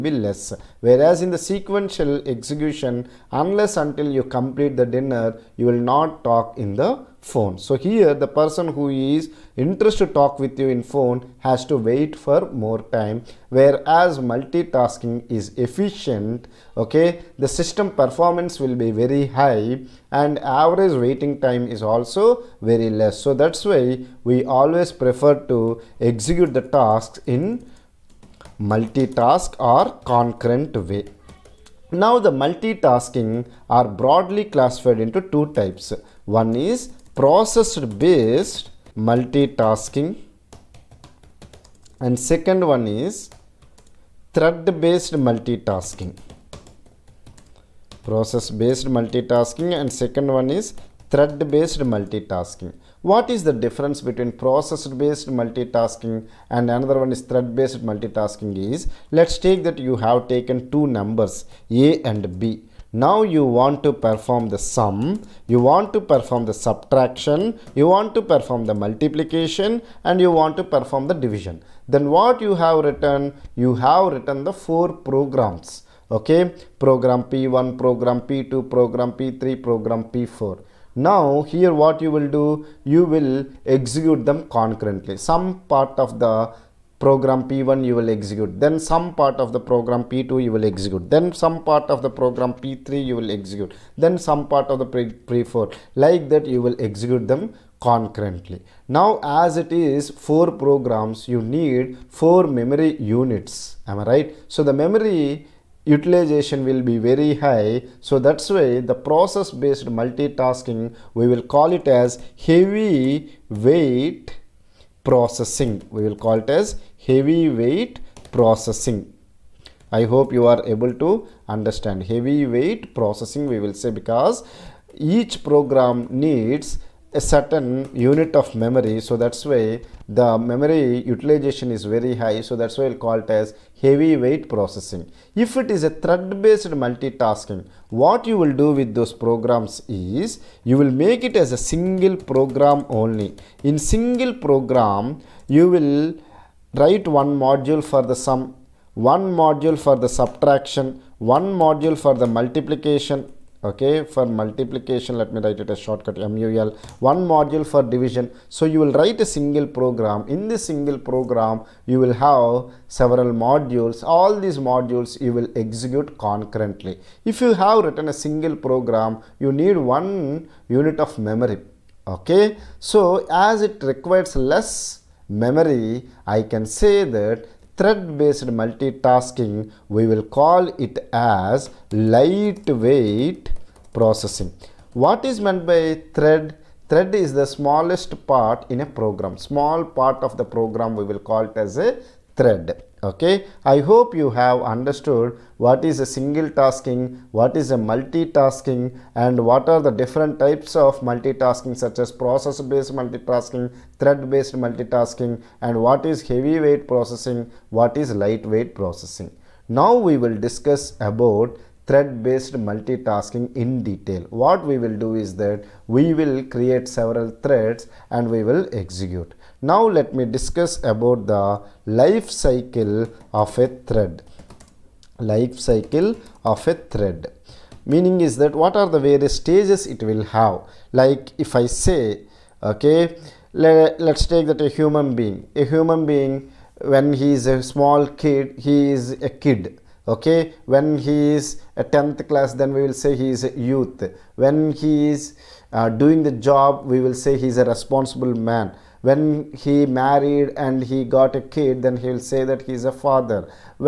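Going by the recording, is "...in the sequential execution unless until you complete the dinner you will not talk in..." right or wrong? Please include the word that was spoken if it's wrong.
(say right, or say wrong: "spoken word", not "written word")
right.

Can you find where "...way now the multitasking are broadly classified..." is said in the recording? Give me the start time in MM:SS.
00:30.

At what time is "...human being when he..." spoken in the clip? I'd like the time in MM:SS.
03:55.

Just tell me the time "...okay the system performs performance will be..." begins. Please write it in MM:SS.
00:16.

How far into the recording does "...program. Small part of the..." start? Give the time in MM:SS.
03:08.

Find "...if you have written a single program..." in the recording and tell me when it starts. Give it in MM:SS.
02:47.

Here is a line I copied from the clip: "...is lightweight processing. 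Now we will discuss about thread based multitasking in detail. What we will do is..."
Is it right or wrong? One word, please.
right.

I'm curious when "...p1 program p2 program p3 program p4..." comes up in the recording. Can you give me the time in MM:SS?
01:17.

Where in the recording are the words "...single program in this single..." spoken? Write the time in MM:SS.
02:39.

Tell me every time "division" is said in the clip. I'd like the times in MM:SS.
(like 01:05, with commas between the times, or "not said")
01:11, 02:37.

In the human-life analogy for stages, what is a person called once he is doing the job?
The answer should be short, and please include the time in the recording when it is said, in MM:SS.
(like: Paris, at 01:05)
responsible man, at 04:07.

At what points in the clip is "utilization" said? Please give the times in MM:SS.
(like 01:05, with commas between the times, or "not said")
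01:45, 02:11.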